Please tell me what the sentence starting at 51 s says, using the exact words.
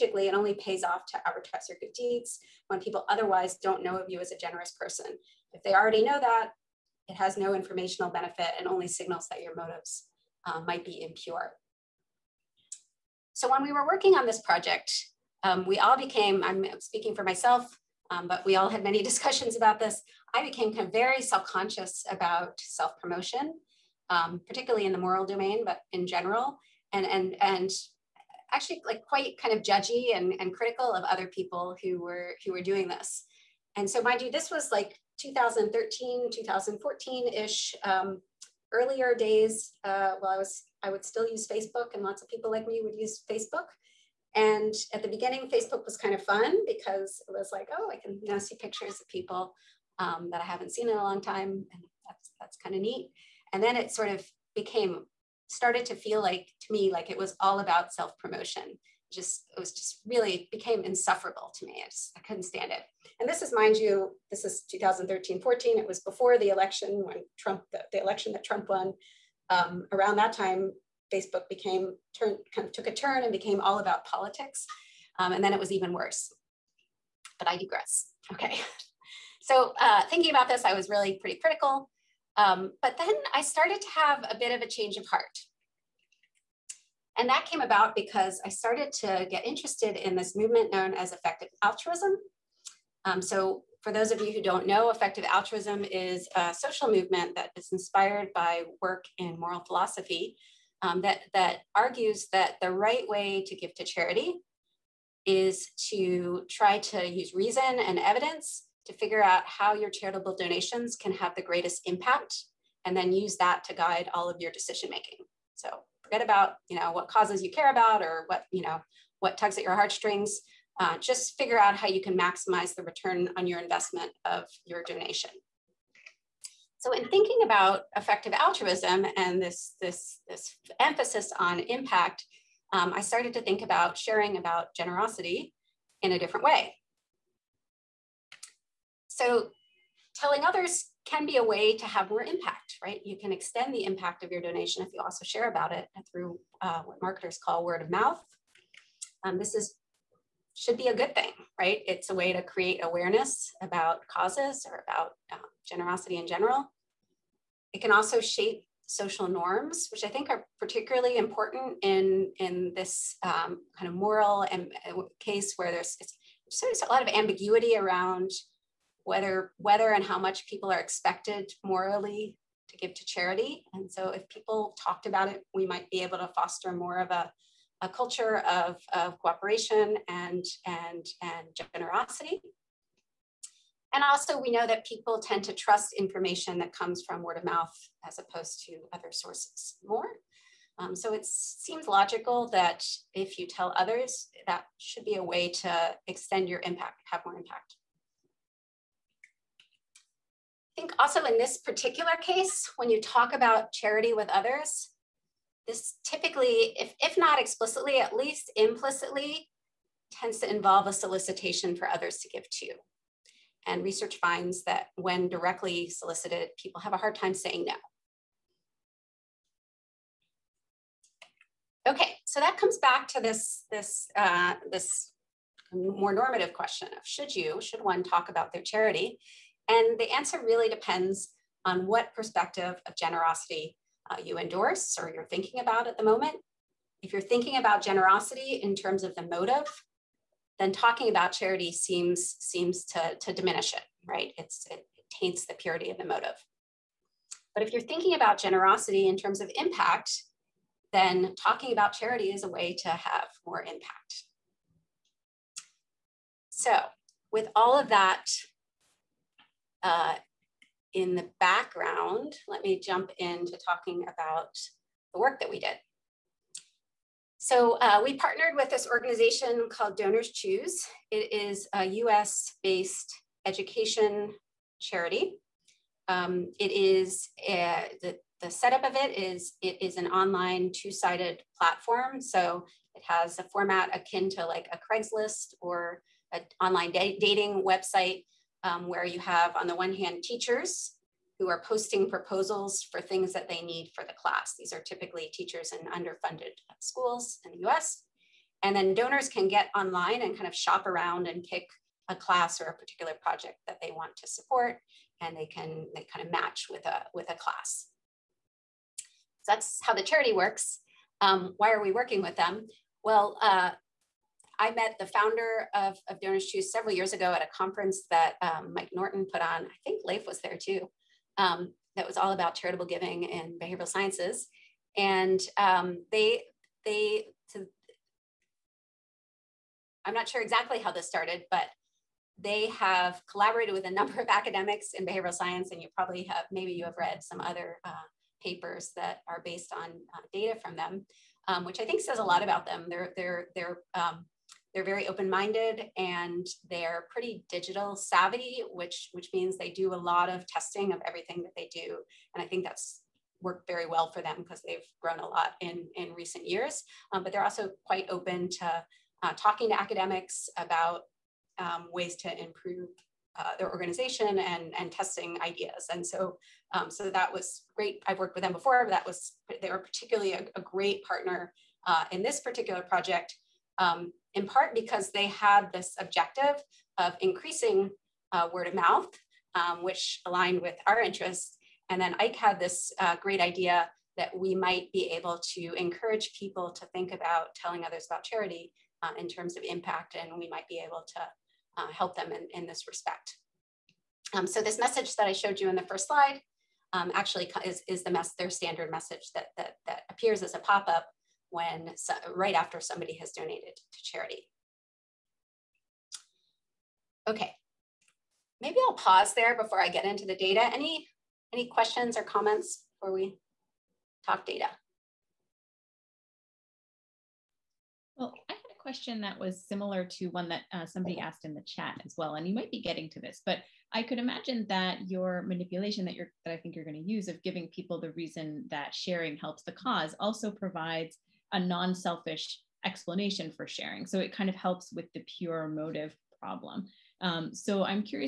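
And that's, that's kind of neat.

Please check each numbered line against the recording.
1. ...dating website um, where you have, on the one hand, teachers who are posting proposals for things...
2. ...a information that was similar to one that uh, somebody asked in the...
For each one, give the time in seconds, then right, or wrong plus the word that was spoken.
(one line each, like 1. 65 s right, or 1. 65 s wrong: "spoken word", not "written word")
1. 287 s right
2. 418 s wrong: "question", not "information".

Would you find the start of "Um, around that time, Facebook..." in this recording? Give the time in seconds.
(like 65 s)
69 s.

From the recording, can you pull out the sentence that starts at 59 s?
Just, it was just really became insufferable to me.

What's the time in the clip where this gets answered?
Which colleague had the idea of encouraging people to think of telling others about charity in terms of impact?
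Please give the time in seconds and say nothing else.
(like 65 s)
382 s.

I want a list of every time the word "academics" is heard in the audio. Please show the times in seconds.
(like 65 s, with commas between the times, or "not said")
334 s, 359 s.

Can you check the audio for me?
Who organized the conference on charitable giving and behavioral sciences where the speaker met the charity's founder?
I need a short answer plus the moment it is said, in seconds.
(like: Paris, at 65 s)
Mike Norton, at 318 s.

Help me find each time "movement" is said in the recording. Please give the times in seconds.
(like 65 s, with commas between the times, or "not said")
90 s, 96 s.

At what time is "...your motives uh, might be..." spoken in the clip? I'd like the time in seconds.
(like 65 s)
9 s.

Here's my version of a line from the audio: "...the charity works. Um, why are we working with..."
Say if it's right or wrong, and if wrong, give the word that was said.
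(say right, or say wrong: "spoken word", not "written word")
right.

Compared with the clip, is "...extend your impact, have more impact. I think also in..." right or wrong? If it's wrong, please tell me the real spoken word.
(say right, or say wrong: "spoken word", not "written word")
right.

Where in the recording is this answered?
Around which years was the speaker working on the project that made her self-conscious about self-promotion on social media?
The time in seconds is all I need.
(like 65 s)
35 s.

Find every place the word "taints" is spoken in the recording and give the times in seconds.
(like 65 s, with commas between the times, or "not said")
245 s.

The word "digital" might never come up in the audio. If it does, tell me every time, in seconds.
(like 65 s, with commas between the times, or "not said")
347 s.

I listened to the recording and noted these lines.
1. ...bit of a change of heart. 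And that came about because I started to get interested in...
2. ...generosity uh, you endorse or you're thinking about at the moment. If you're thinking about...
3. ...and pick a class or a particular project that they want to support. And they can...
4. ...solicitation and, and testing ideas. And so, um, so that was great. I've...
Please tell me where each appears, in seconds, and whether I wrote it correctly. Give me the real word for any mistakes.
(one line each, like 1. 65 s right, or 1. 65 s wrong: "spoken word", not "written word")
1. 84 s right
2. 232 s right
3. 301 s right
4. 363 s wrong: "organization", not "solicitation".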